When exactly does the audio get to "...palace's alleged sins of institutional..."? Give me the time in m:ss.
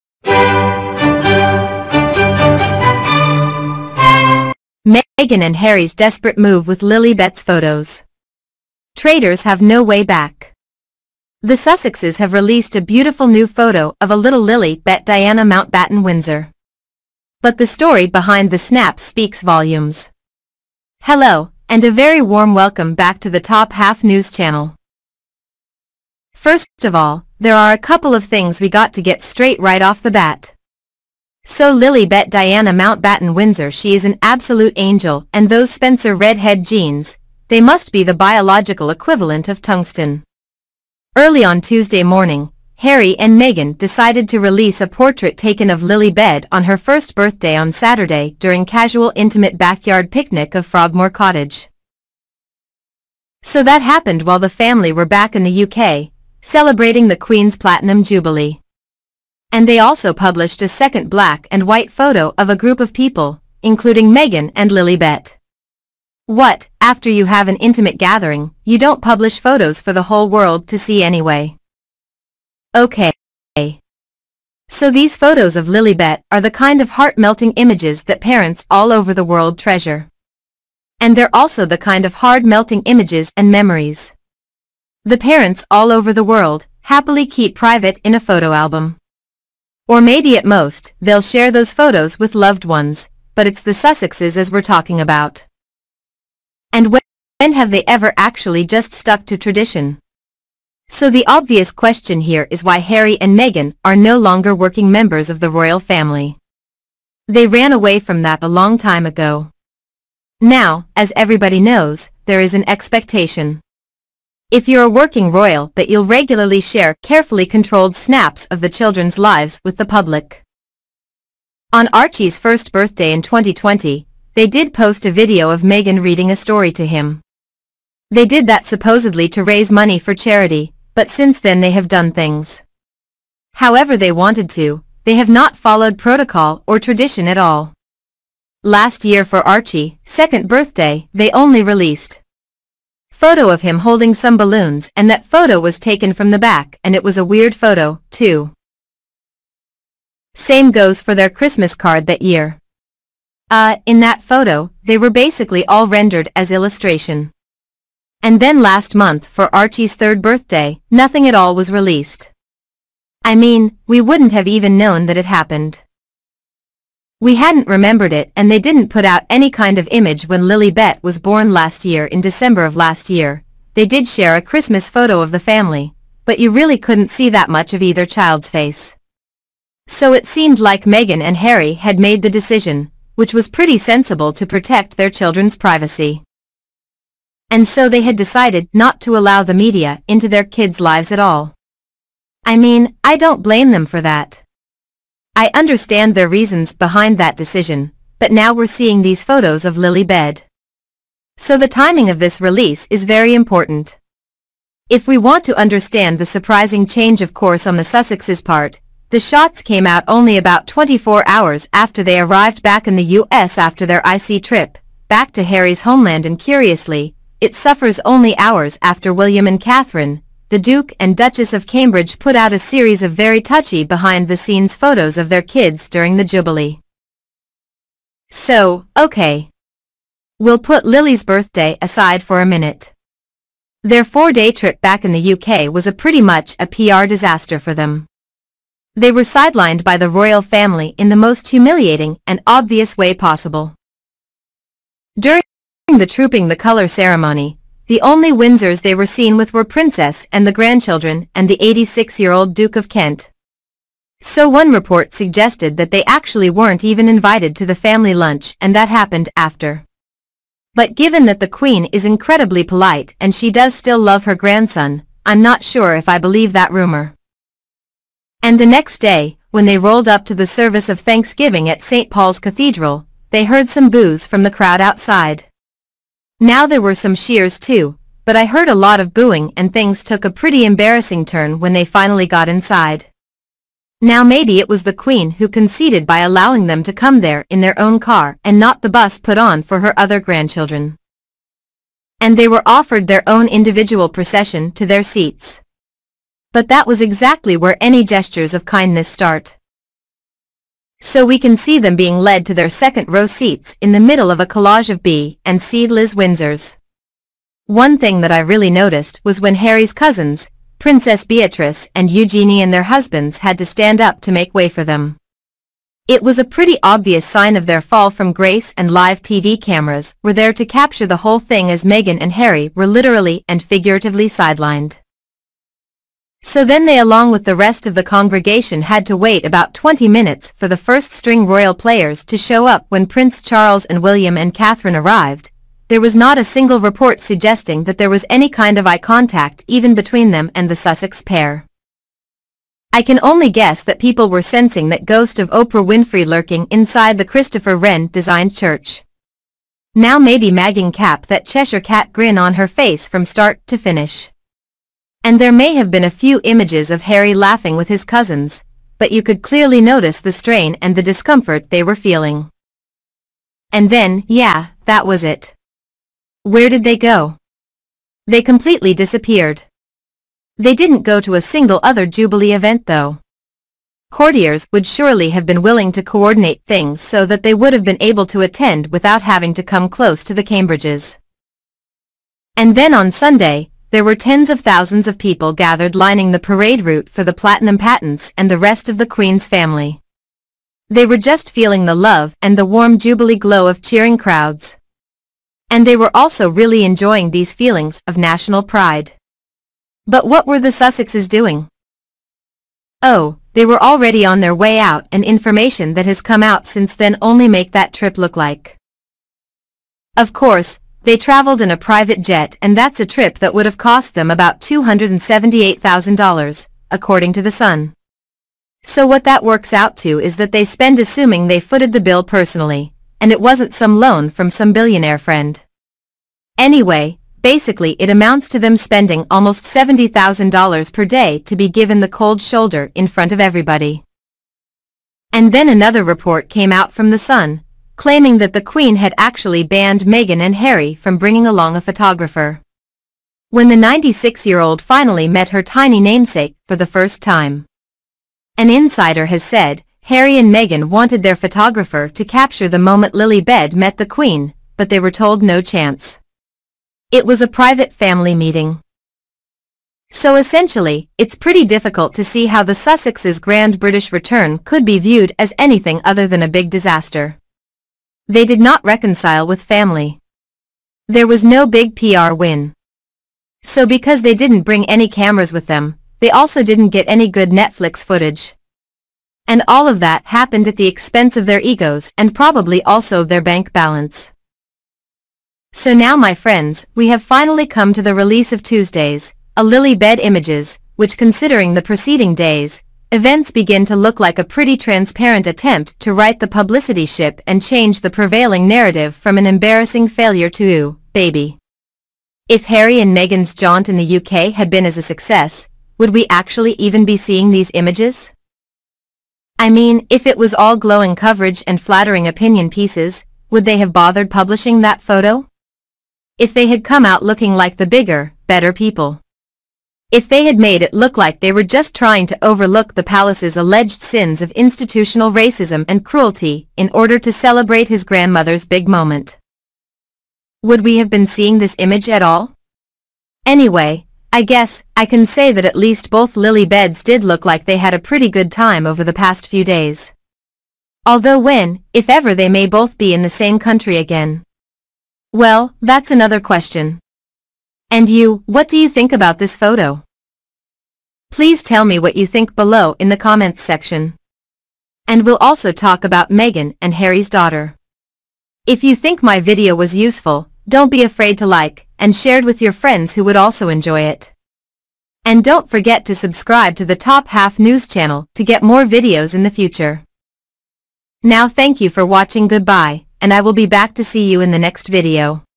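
8:43.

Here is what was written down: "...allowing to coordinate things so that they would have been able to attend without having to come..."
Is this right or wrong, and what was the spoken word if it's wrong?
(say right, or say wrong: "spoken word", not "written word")
wrong: "willing", not "allowing".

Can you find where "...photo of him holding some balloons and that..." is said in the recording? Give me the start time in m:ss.
2:23.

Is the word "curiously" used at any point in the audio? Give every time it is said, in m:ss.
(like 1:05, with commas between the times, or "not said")
3:36.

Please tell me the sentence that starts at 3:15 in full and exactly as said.
I understand their reasons behind that decision, but now we're seeing these photos of Lilibet.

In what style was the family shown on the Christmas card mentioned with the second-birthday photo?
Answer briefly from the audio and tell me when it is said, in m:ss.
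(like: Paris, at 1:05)
As illustration, at 2:36.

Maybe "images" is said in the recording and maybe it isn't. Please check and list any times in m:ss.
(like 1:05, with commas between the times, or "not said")
1:17, 1:22, 2:49, 5:56, 8:10, 8:27, 8:51.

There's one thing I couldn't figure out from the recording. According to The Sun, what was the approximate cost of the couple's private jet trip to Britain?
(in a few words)
$278,000.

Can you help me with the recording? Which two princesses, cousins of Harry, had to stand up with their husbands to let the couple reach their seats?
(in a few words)
Beatrice and Eugenie.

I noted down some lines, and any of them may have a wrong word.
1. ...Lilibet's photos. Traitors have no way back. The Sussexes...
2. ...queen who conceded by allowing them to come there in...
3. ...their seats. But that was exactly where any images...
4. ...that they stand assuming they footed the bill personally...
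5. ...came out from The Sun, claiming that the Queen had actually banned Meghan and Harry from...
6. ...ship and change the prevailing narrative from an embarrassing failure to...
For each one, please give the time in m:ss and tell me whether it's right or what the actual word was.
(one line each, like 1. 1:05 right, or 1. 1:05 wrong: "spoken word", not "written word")
1. 0:06 right
2. 4:44 right
3. 4:54 wrong: "gestures", not "images"
4. 7:00 wrong: "spend", not "stand"
5. 7:16 right
6. 8:17 right.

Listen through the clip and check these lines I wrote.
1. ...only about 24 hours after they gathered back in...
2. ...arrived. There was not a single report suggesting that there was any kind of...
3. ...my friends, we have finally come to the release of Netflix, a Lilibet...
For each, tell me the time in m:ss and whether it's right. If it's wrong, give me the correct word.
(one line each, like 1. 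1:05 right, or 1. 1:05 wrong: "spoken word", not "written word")
1. 3:30 wrong: "arrived", not "gathered"
2. 5:34 right
3. 8:06 wrong: "Tuesdays", not "Netflix".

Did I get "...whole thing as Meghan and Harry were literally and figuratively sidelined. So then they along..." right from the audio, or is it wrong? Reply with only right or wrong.
right.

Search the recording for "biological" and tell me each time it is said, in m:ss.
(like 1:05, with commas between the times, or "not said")
0:38.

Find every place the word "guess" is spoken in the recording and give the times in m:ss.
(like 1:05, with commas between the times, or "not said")
5:43, 8:54.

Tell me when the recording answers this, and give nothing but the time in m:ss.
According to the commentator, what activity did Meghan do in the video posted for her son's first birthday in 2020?
2:06.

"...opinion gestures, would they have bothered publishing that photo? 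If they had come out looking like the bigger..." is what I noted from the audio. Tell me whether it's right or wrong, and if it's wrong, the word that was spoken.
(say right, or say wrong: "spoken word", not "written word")
wrong: "pieces", not "gestures".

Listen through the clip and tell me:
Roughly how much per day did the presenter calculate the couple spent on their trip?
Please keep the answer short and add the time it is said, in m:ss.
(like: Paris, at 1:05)
$70,000, at 7:09.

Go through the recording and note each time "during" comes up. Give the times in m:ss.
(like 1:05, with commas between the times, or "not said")
0:48, 3:45, 4:05.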